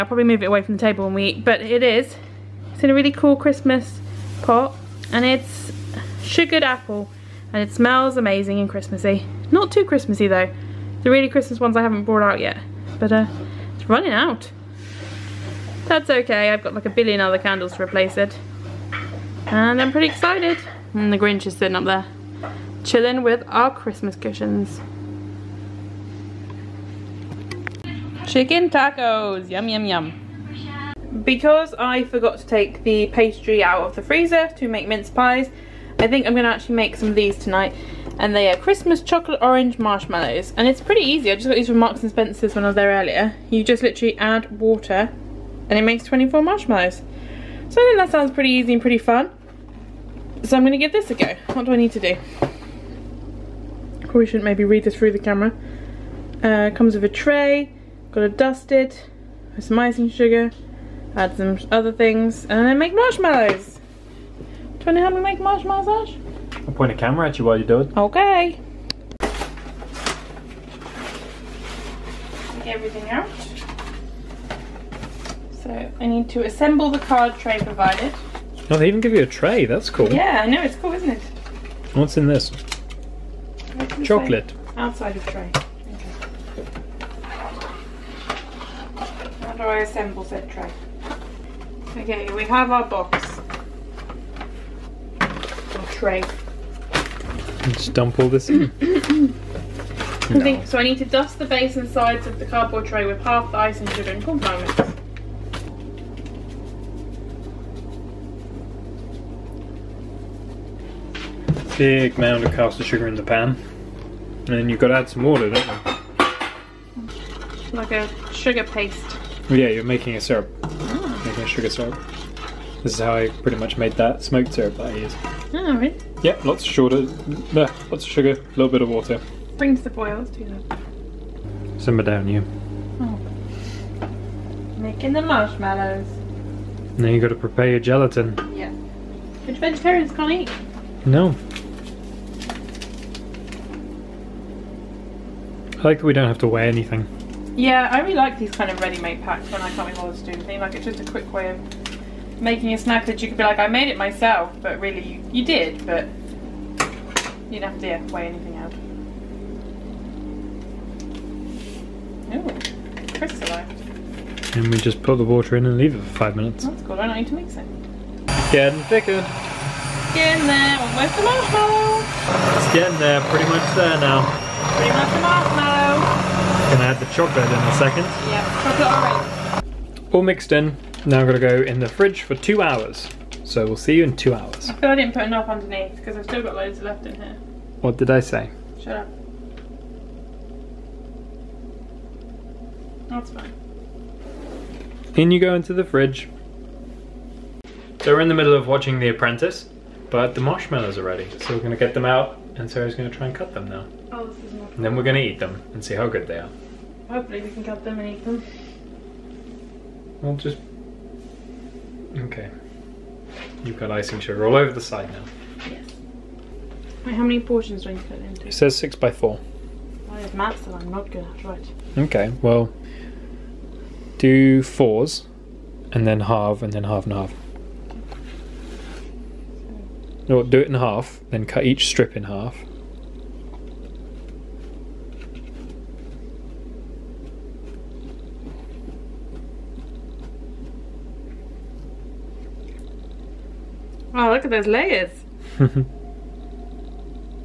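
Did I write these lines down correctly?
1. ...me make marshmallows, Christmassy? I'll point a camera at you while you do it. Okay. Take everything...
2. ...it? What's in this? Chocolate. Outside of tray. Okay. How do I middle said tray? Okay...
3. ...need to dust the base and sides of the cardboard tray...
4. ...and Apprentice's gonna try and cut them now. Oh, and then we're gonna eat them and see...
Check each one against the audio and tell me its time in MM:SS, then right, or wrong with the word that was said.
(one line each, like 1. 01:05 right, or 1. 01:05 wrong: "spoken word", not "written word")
1. 01:05 wrong: "Ash", not "Christmassy"
2. 01:21 wrong: "assemble", not "middle"
3. 01:40 right
4. 03:22 wrong: "Sarah", not "Apprentice".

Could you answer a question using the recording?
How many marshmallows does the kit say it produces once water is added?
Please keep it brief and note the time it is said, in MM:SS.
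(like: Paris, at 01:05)
24, at 00:46.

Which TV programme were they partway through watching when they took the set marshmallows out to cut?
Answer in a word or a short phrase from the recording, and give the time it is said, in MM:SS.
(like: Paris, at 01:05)
The Apprentice, at 03:18.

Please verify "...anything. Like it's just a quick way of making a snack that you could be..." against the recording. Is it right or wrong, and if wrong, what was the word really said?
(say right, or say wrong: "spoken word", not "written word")
right.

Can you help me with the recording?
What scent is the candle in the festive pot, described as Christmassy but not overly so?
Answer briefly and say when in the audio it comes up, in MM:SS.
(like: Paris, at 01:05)
Sugared apple, at 00:06.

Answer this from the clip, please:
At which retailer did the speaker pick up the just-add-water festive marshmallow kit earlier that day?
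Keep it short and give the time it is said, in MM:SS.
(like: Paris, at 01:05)
Marks and Spencer's, at 00:41.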